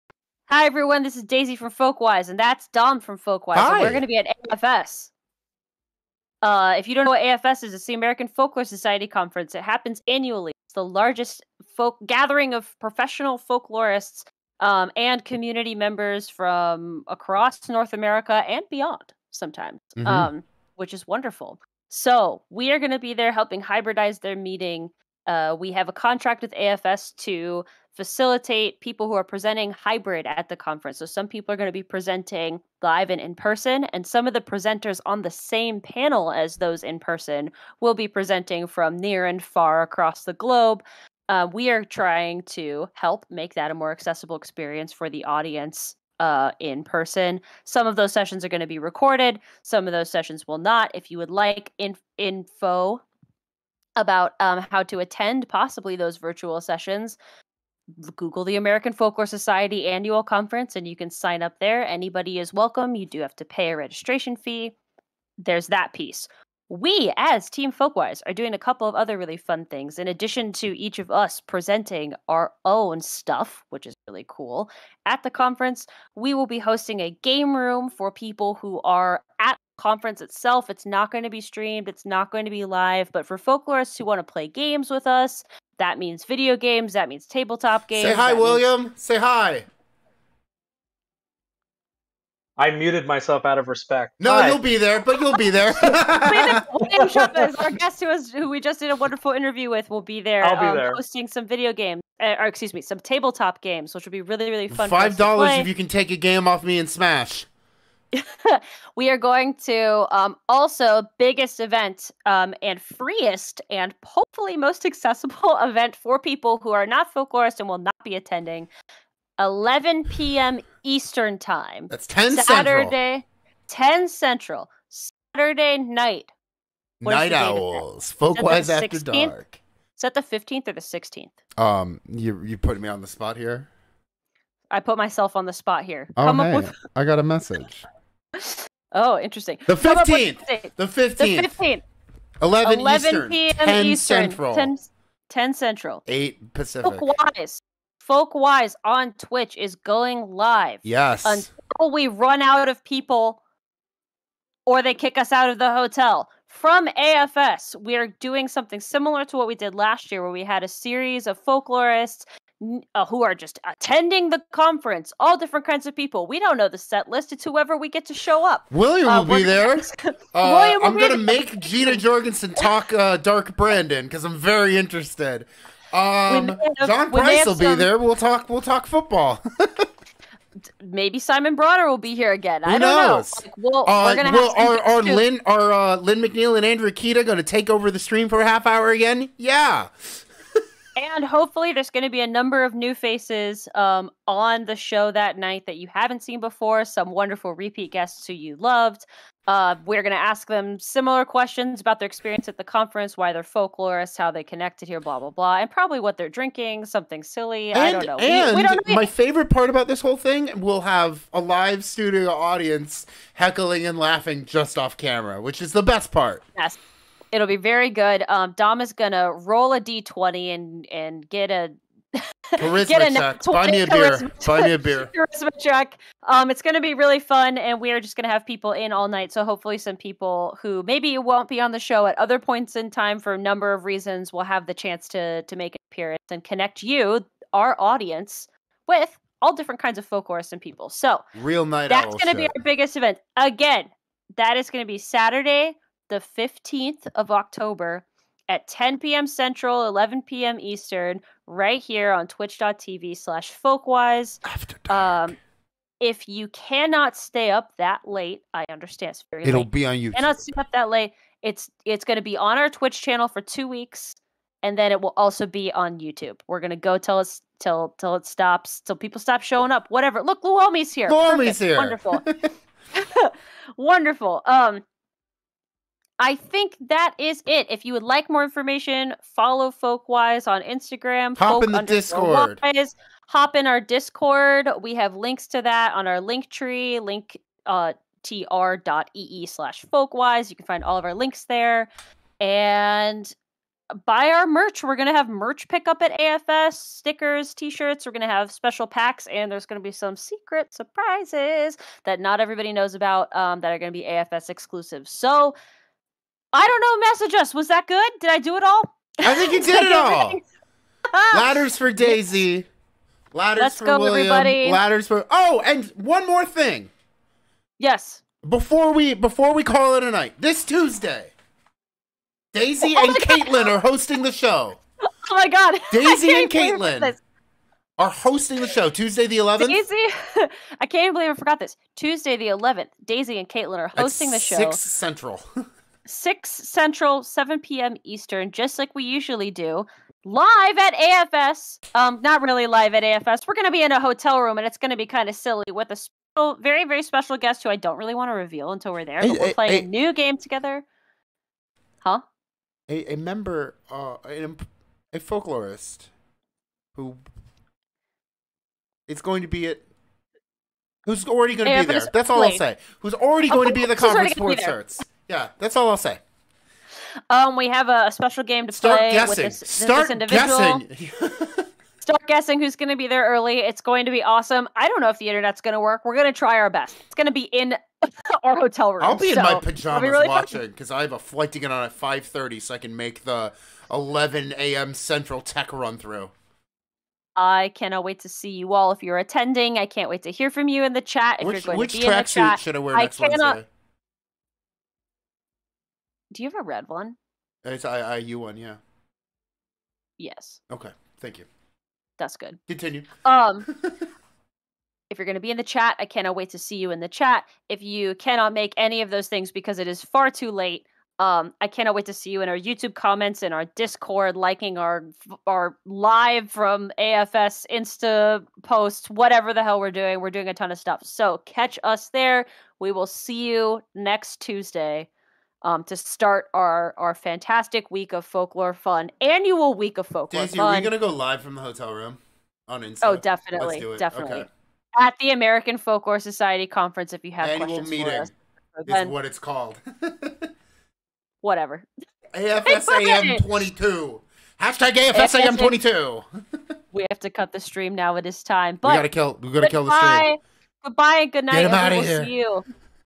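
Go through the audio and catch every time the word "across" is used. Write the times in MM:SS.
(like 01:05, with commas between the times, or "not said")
00:17, 00:39.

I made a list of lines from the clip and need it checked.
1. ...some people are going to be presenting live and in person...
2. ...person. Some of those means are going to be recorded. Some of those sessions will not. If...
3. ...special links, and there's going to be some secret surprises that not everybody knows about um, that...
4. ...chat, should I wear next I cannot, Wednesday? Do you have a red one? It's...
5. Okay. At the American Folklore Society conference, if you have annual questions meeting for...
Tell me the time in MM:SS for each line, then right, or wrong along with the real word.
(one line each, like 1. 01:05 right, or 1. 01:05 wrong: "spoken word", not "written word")
1. 00:31 right
2. 00:46 wrong: "sessions", not "means"
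3. 04:58 wrong: "packs", not "links"
4. 06:32 right
5. 07:14 right.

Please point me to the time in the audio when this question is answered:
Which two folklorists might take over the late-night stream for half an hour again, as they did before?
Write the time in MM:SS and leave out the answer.
03:05.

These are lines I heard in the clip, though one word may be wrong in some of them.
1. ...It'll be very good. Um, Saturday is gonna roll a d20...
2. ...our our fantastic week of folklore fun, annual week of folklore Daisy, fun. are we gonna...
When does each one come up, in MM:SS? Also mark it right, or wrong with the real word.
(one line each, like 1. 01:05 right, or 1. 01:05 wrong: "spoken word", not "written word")
1. 03:37 wrong: "Dom", not "Saturday"
2. 07:06 right.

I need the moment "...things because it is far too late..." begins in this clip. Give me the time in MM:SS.
06:49.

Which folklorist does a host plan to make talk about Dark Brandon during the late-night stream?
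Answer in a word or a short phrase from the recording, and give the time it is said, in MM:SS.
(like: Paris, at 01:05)
Jeana Jorgensen, at 02:51.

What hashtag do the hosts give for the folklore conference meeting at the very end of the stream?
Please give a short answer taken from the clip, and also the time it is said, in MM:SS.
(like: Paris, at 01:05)
#AFSAM22, at 07:24.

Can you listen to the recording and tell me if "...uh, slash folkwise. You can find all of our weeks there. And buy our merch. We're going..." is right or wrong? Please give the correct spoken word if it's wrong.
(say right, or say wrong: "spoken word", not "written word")
wrong: "links", not "weeks".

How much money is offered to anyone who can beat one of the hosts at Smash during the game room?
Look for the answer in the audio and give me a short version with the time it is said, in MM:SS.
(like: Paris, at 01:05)
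$5, at 01:44.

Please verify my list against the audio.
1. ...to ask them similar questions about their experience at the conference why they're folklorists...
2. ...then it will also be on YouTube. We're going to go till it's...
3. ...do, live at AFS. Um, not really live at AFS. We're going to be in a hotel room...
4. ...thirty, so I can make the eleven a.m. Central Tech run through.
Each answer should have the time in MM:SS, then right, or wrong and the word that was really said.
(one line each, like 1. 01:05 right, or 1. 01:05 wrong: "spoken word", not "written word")
1. 03:20 right
2. 04:24 right
3. 05:39 right
4. 06:22 right.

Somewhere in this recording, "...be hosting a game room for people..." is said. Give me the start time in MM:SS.
01:16.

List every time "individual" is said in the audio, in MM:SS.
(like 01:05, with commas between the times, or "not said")
06:10.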